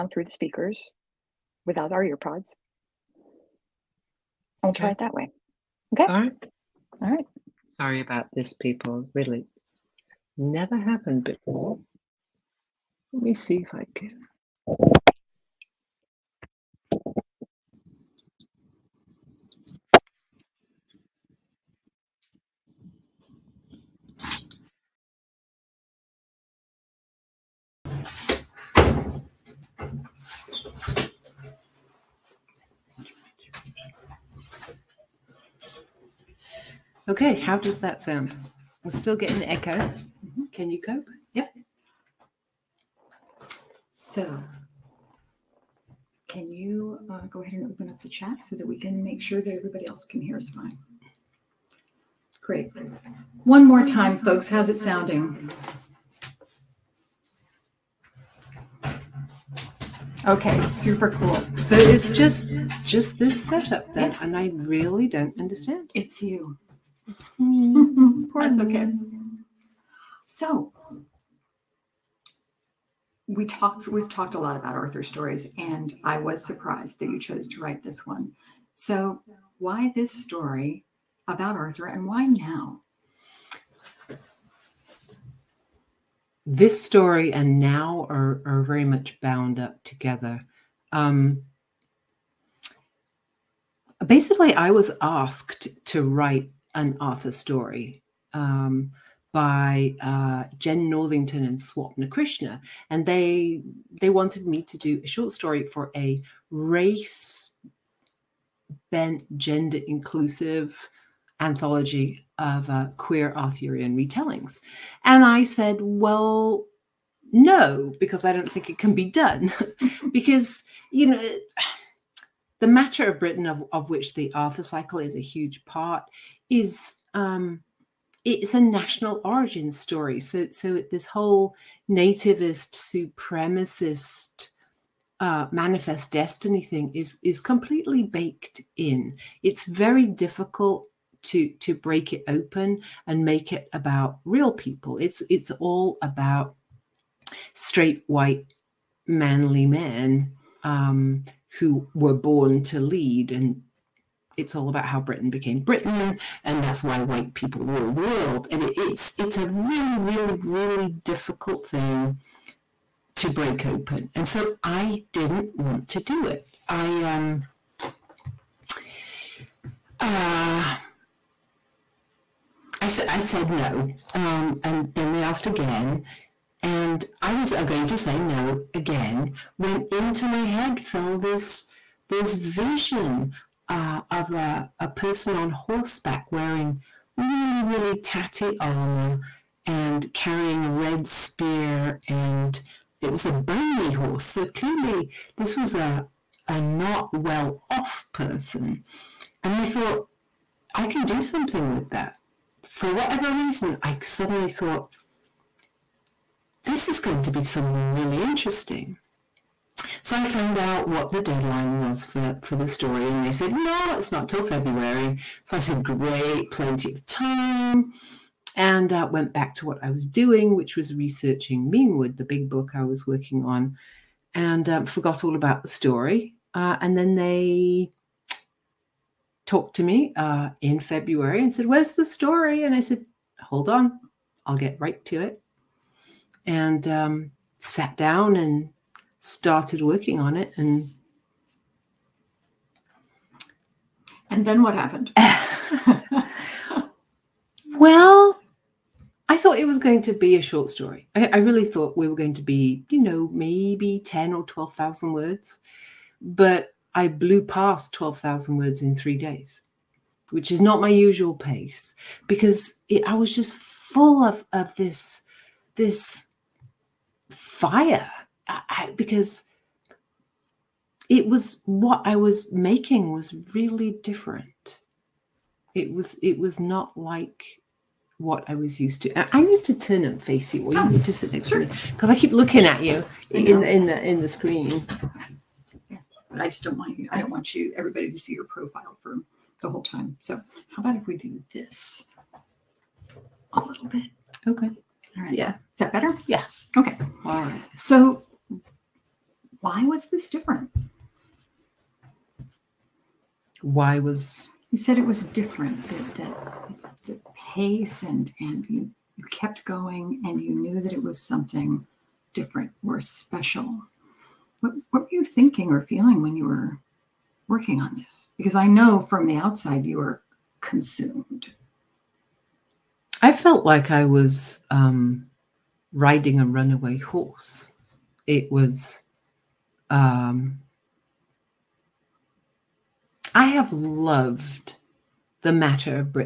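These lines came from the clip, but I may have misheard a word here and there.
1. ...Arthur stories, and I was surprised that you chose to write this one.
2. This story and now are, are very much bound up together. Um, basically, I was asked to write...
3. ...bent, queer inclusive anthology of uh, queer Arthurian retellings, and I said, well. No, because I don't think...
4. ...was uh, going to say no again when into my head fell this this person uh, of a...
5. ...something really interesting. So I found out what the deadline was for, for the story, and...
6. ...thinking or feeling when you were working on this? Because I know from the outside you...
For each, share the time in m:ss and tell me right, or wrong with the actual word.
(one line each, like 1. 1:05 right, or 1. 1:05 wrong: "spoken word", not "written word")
1. 1:14 right
2. 1:26 right
3. 1:48 wrong: "gender", not "queer"
4. 2:57 wrong: "vision", not "person"
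5. 3:27 right
6. 5:15 right.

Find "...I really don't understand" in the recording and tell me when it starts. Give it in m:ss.
1:04.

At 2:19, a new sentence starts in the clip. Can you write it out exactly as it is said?
It's very difficult to to break it open and make it about real people.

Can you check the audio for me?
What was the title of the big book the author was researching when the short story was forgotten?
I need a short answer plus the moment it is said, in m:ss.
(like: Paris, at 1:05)
Menewood, at 3:41.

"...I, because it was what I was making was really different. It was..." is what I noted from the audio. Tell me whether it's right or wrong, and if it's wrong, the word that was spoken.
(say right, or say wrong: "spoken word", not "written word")
right.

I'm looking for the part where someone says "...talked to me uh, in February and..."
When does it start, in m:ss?
3:49.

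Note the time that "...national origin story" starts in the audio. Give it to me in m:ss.
2:08.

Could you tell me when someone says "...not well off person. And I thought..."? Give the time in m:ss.
3:16.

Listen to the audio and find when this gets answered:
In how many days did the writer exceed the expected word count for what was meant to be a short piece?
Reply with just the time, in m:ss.
4:18.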